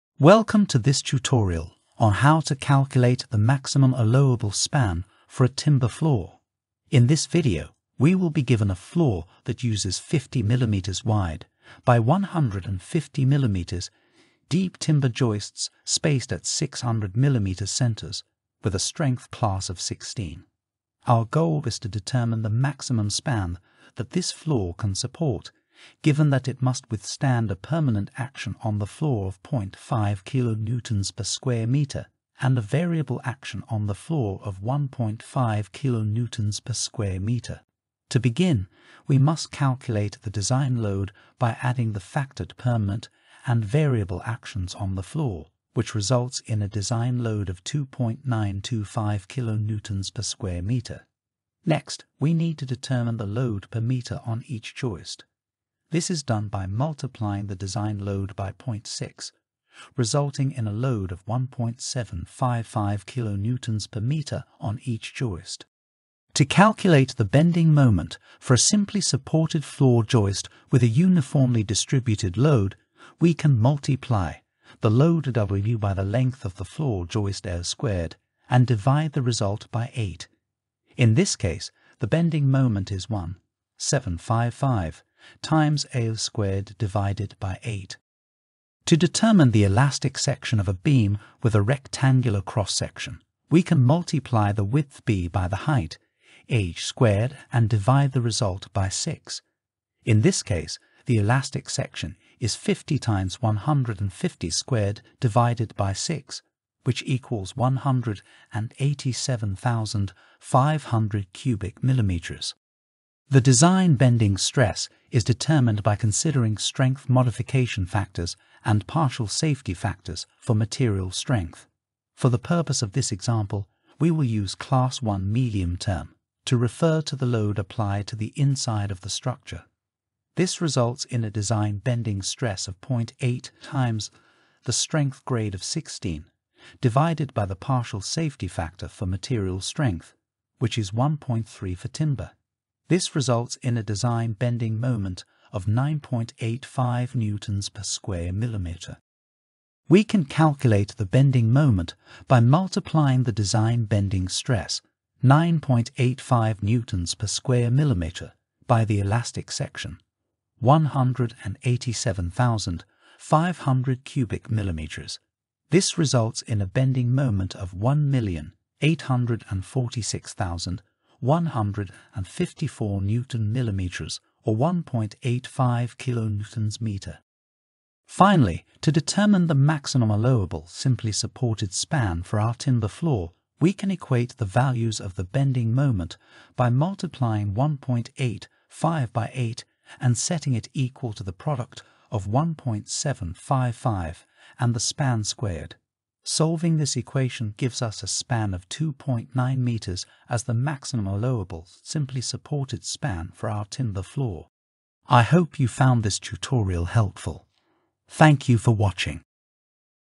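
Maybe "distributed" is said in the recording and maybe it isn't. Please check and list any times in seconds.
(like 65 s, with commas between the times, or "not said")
71 s.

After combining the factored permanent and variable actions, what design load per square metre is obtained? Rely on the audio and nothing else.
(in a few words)
2.925 kN/m².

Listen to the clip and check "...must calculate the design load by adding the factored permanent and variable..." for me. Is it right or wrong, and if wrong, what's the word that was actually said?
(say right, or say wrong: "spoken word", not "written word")
right.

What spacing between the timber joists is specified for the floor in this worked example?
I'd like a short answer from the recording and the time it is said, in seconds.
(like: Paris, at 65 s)
600 mm centers, at 16 s.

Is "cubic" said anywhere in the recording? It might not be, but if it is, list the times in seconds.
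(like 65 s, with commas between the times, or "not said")
111 s, 164 s.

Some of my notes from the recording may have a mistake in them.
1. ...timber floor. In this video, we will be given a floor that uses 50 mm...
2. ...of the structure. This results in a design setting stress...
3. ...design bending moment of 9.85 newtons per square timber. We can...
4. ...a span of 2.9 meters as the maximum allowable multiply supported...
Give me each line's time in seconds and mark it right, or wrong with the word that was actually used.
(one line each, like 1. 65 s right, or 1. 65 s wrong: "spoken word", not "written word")
1. 5 s right
2. 128 s wrong: "bending", not "setting"
3. 143 s wrong: "millimeter", not "timber"
4. 198 s wrong: "simply", not "multiply".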